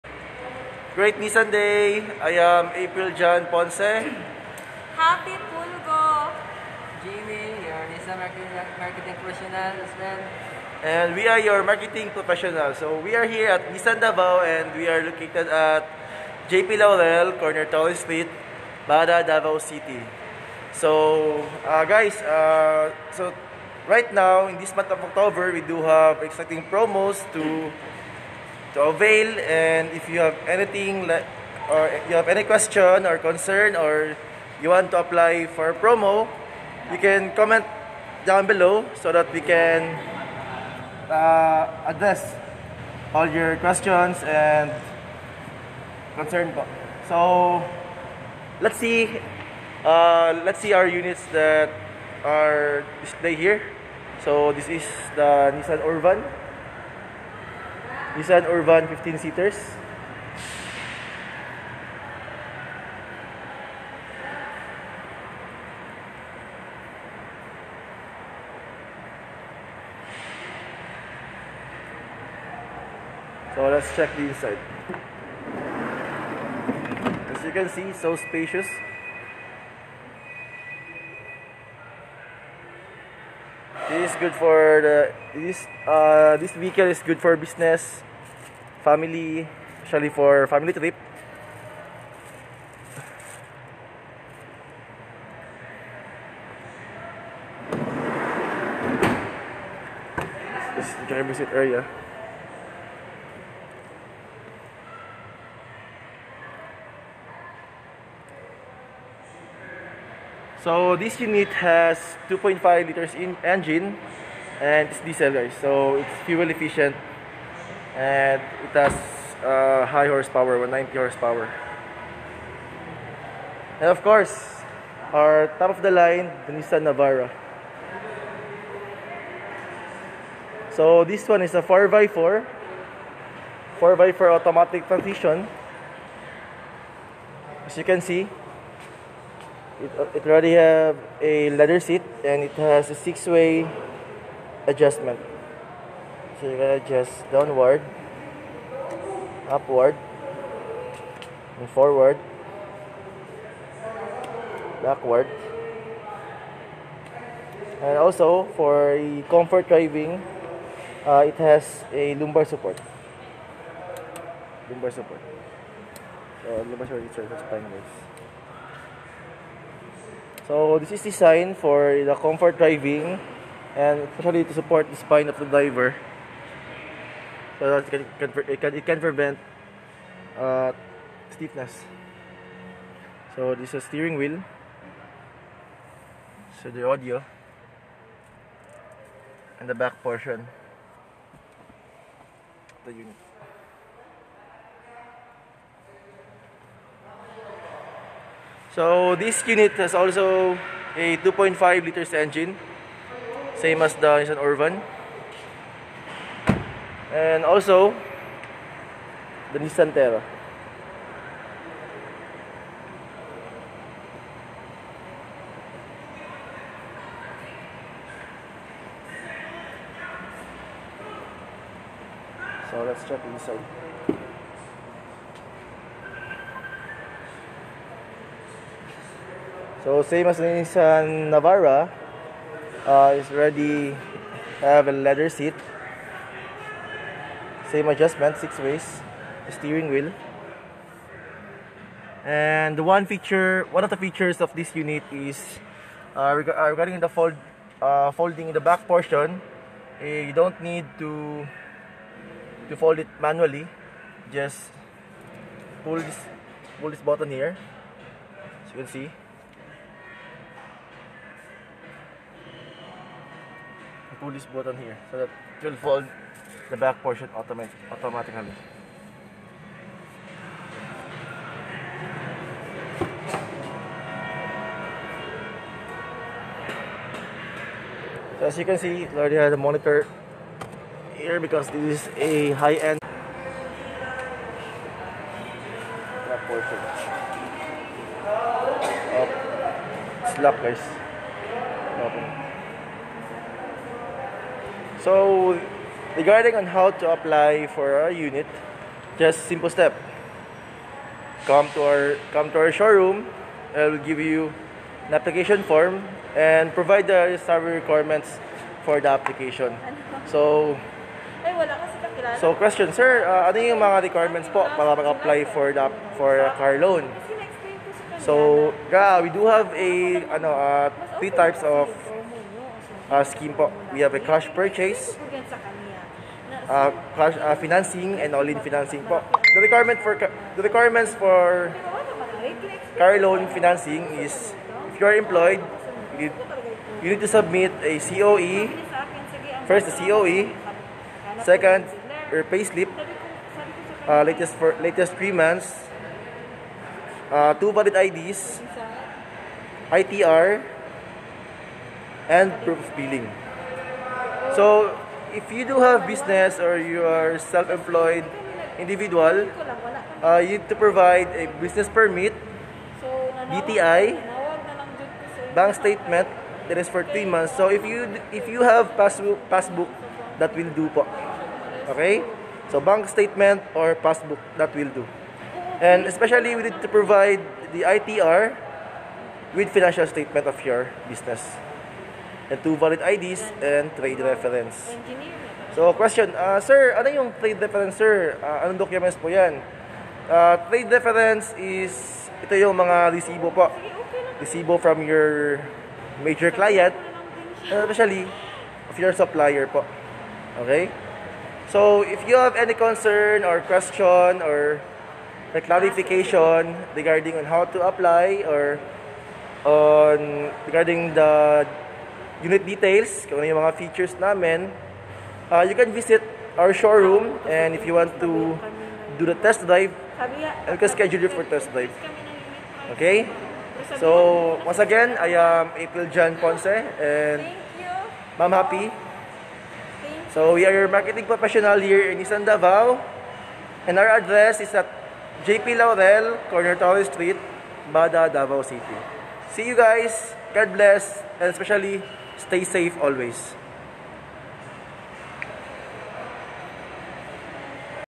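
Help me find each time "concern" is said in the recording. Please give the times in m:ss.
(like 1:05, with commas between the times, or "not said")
0:33, 0:46, 6:42.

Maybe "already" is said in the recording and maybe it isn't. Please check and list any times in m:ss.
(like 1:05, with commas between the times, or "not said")
2:20, 3:53, 4:39.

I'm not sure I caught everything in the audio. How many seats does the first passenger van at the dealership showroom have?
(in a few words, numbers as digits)
15.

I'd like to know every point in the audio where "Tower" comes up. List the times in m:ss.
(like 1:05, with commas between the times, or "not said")
0:17, 7:16.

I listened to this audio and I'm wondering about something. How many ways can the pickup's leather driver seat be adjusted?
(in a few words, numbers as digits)
Six.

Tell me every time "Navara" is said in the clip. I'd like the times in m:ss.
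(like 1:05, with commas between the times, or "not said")
2:06, 3:51.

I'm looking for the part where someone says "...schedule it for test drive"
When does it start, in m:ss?
7:00.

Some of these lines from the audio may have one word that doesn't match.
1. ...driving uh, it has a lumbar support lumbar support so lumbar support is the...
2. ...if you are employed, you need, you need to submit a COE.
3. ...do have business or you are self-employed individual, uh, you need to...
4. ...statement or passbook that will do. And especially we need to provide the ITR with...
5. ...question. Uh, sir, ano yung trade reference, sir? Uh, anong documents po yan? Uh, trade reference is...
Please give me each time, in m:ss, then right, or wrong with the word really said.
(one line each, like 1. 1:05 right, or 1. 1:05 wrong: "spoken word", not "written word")
1. 2:39 right
2. 5:34 right
3. 5:55 right
4. 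6:13 right
5. 6:25 right.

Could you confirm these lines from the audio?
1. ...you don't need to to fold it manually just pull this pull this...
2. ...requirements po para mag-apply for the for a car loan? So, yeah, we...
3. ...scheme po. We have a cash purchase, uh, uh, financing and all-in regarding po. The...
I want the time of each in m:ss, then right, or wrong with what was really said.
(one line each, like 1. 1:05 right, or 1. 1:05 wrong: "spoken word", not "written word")
1. 4:10 right
2. 5:14 right
3. 5:23 wrong: "financing", not "regarding".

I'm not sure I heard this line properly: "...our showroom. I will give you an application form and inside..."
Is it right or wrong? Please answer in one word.
wrong.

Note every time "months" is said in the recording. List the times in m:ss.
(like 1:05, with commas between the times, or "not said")
0:24, 5:45, 6:07.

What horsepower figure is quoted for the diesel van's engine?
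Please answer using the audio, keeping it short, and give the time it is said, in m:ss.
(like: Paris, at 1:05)
190 horsepower, at 2:00.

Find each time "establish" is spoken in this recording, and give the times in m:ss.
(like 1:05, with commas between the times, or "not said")
not said.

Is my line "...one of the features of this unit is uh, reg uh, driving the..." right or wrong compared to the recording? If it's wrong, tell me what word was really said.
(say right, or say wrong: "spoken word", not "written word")
wrong: "regarding", not "driving".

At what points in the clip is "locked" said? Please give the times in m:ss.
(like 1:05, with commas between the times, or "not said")
4:50.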